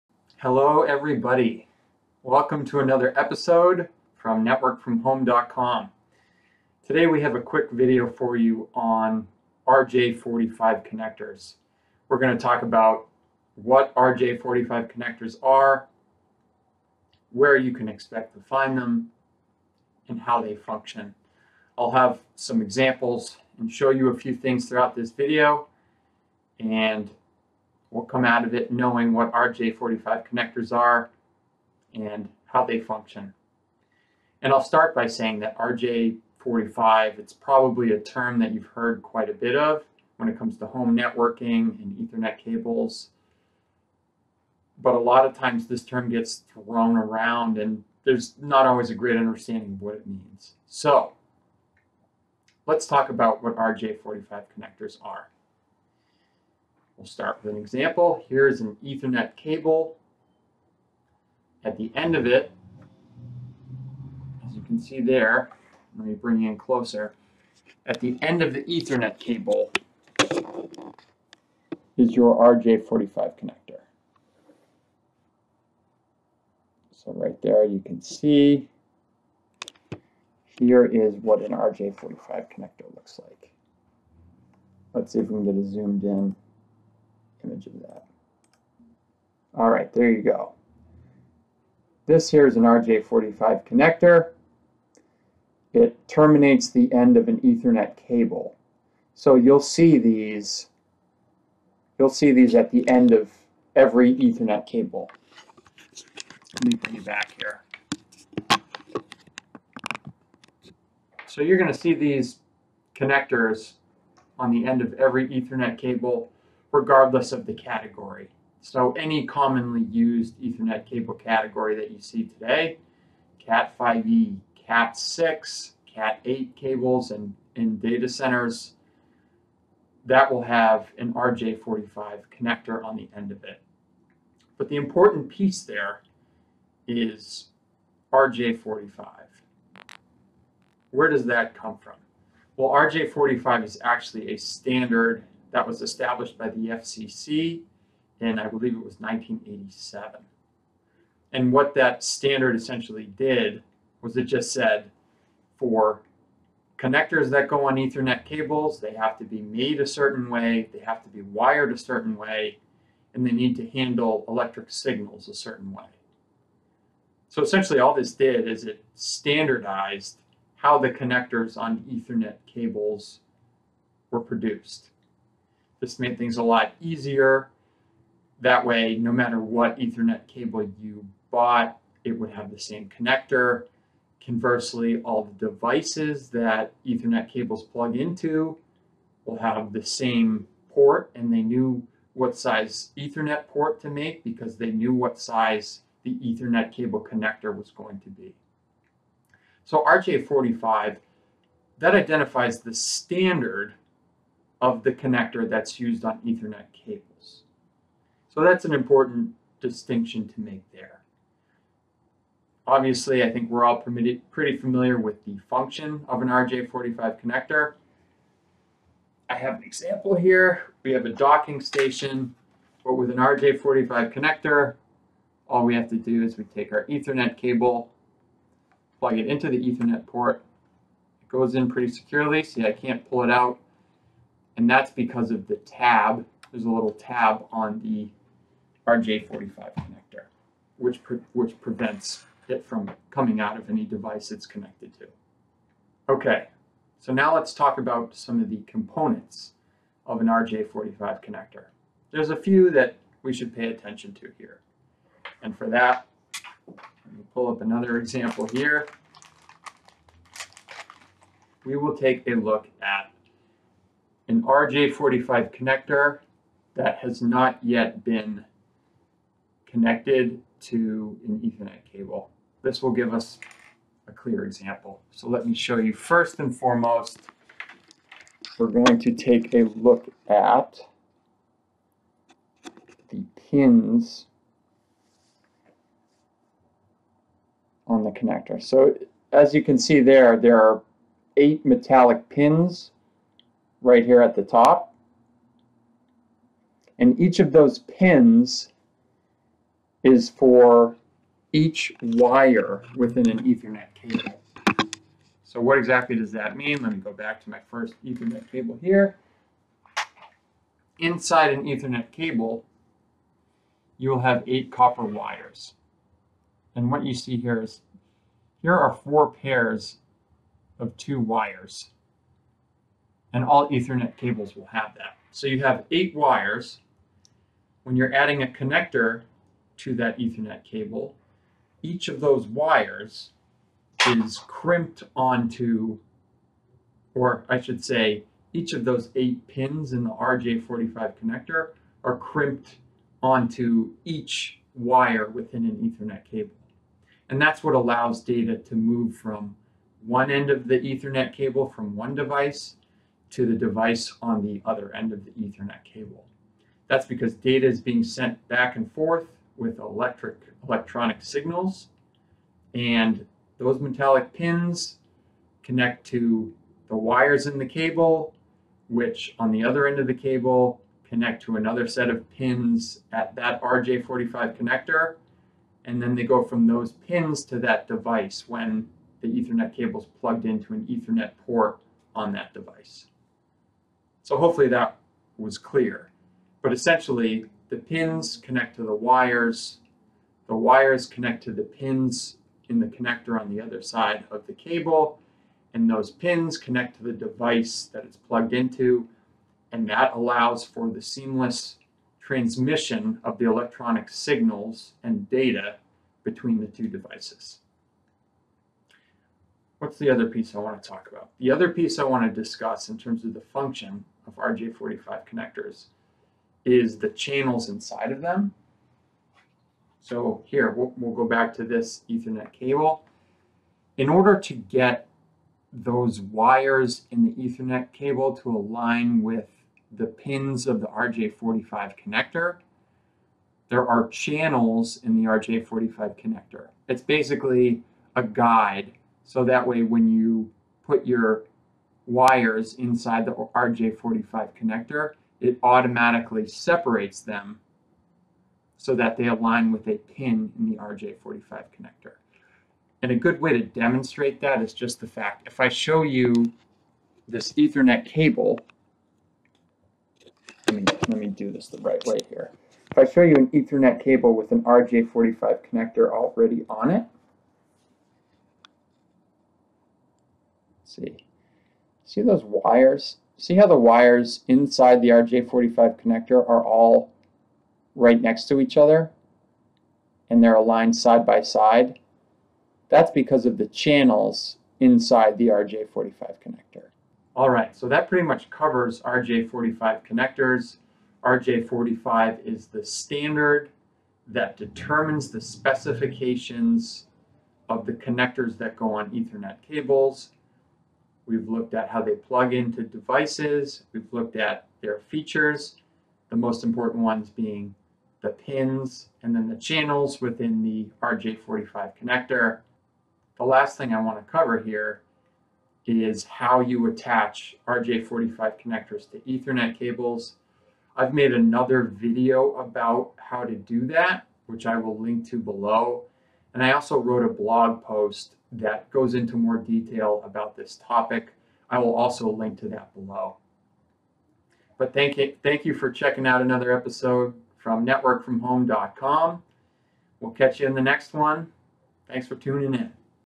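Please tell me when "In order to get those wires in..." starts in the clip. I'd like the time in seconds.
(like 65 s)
423 s.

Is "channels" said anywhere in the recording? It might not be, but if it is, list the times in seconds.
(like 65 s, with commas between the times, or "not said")
417 s, 434 s, 483 s, 509 s.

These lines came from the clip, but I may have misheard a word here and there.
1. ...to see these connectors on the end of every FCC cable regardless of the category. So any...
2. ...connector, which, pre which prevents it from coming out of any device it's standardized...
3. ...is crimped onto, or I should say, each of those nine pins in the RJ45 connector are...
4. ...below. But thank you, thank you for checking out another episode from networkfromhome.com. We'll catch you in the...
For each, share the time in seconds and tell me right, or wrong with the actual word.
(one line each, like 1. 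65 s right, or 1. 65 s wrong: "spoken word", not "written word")
1. 111 s wrong: "Ethernet", not "FCC"
2. 239 s wrong: "connected", not "standardized"
3. 334 s wrong: "eight", not "nine"
4. 532 s right.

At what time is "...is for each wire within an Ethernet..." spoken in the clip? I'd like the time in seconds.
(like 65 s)
300 s.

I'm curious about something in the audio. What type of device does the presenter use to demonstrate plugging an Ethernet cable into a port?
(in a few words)
Docking station.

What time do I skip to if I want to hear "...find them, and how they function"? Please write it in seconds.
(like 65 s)
18 s.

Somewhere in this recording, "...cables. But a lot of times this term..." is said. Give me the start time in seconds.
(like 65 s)
42 s.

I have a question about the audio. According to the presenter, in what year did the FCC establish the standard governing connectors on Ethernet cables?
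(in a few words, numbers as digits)
1987.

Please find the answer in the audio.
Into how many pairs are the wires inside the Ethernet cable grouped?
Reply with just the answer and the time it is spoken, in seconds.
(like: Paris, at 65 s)
4, at 319 s.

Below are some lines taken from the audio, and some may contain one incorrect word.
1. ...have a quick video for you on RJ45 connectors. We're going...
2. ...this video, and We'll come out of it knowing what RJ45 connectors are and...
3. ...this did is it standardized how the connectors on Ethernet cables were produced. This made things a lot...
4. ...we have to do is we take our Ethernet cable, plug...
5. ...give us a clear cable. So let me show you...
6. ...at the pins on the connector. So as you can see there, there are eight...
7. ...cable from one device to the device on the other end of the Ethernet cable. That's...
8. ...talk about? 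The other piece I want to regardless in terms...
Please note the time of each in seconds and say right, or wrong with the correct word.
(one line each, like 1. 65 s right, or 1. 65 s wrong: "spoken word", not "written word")
1. 7 s right
2. 24 s right
3. 167 s right
4. 225 s right
5. 272 s wrong: "example", not "cable"
6. 280 s right
7. 351 s right
8. 410 s wrong: "discuss", not "regardless".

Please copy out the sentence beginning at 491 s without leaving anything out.
RJ45 is the standard that determines the specifications of the connectors that go on Ethernet cables.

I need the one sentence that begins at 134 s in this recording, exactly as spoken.
But the important piece there is RJ45.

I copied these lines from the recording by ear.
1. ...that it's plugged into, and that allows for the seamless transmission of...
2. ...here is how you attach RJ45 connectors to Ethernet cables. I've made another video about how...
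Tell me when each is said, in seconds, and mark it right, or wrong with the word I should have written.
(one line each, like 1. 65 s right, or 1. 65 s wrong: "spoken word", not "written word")
1. 397 s right
2. 514 s right.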